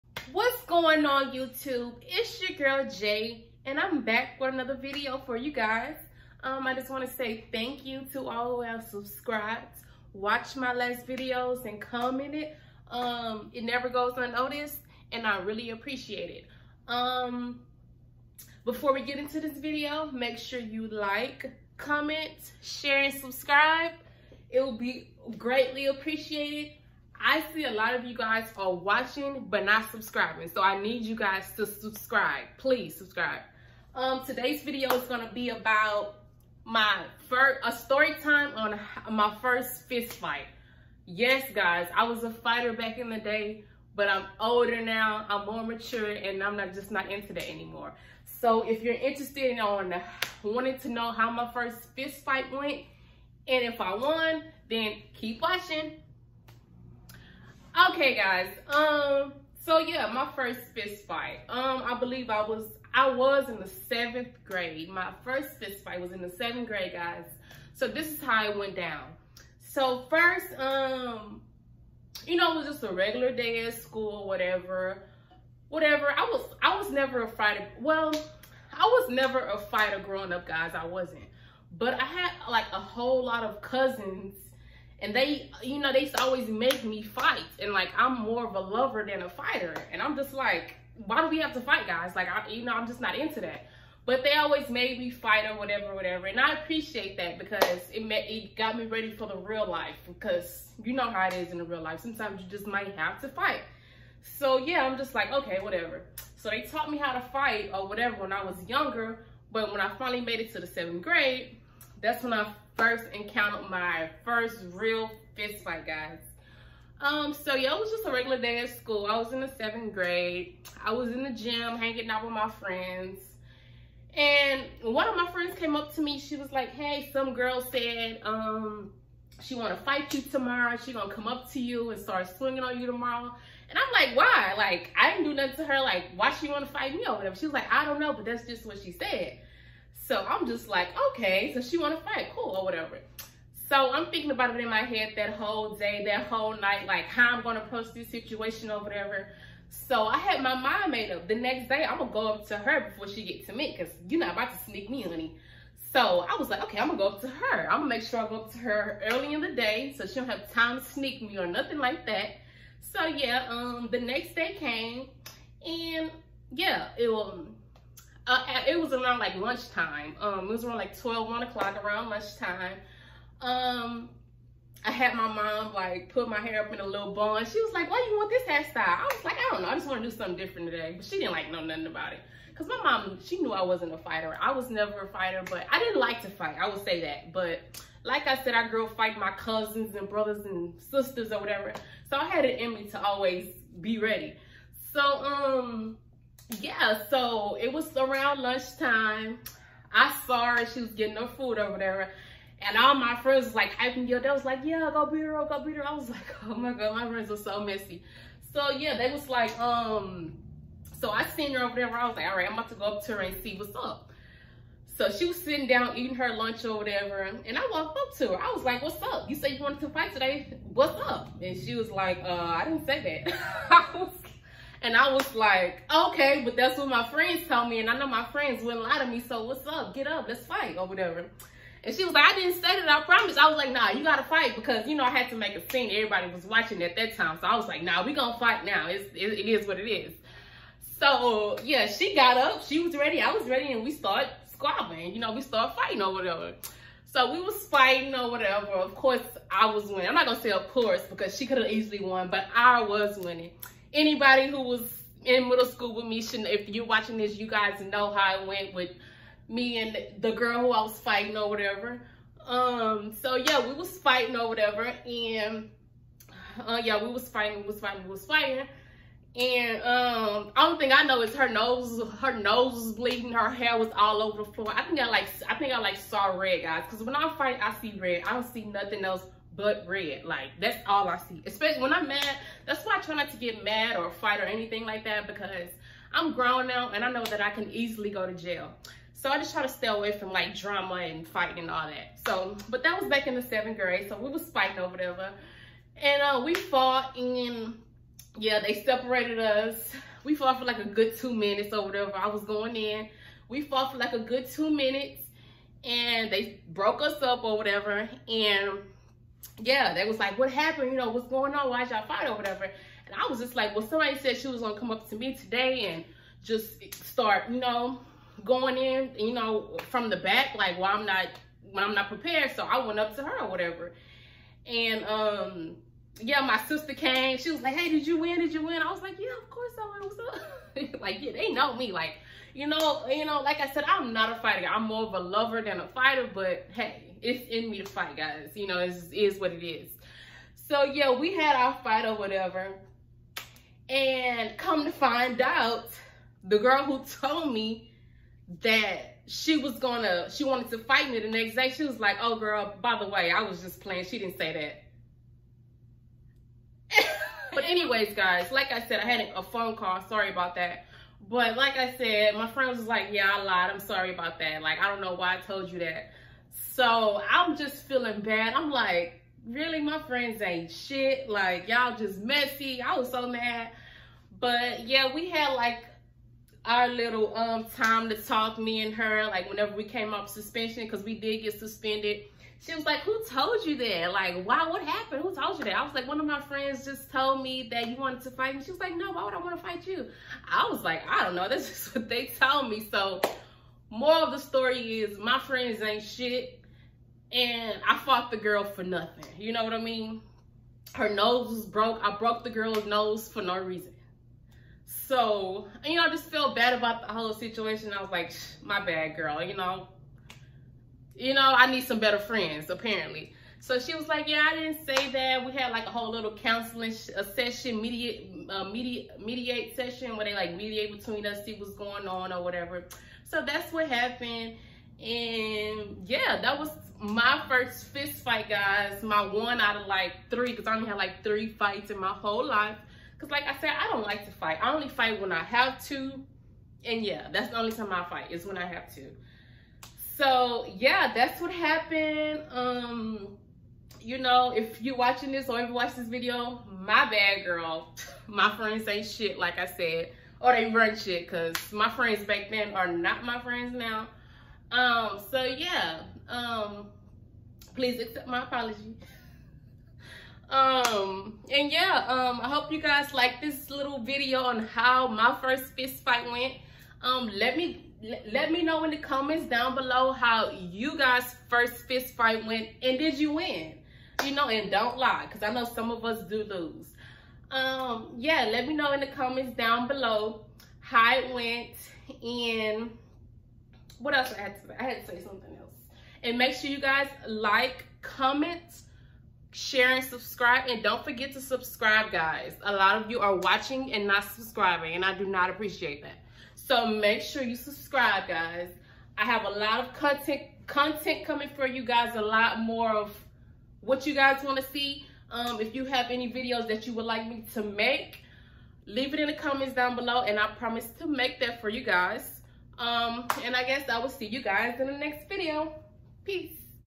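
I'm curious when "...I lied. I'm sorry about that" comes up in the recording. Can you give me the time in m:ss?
6:03.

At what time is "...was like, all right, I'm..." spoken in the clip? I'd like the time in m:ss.
3:32.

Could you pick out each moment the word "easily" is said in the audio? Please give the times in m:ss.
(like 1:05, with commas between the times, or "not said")
4:11, 4:47.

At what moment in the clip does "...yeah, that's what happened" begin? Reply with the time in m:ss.
7:20.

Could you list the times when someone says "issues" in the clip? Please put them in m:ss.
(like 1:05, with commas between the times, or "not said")
not said.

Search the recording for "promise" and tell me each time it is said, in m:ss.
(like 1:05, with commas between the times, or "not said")
3:53, 8:30.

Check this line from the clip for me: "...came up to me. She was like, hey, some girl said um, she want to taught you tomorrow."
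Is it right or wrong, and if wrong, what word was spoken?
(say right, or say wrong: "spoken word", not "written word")
wrong: "fight", not "taught".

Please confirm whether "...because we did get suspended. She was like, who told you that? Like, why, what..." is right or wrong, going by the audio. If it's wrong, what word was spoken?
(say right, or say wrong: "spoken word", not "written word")
right.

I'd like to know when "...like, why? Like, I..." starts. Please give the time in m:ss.
2:14.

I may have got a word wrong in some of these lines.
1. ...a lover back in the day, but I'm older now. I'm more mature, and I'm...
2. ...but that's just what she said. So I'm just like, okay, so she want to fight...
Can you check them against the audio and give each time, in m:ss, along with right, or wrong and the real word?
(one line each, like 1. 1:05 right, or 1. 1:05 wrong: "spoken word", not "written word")
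1. 0:42 wrong: "fighter", not "lover"
2. 2:18 right.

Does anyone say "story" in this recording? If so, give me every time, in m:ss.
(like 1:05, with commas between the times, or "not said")
0:37, 6:34.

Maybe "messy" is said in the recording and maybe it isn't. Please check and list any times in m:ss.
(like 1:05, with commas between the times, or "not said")
3:27, 6:12.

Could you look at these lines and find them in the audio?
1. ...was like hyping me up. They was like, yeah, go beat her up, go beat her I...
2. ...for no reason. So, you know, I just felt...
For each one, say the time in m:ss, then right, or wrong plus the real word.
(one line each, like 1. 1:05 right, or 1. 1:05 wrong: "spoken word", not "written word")
1. 3:23 right
2. 6:43 right.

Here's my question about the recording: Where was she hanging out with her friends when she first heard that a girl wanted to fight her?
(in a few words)
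the gym.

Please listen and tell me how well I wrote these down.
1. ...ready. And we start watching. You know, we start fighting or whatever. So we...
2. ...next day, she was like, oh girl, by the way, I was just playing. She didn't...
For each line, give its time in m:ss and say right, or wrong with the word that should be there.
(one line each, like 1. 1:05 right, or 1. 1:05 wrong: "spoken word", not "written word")
1. 4:03 wrong: "squabbling", not "watching"
2. 5:51 right.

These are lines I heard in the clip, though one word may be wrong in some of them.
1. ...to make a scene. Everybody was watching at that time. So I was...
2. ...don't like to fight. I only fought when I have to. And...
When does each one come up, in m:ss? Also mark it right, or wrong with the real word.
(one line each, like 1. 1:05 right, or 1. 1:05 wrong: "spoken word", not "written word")
1. 3:55 right
2. 7:13 wrong: "fight", not "fought".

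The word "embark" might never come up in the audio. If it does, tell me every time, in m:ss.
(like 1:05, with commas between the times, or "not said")
not said.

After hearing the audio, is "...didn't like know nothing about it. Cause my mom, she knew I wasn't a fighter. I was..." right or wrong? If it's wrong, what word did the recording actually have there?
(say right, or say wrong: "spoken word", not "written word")
right.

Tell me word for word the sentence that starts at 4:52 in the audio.
So, but that was back in the seventh grade.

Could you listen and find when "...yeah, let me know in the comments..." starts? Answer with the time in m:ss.
7:58.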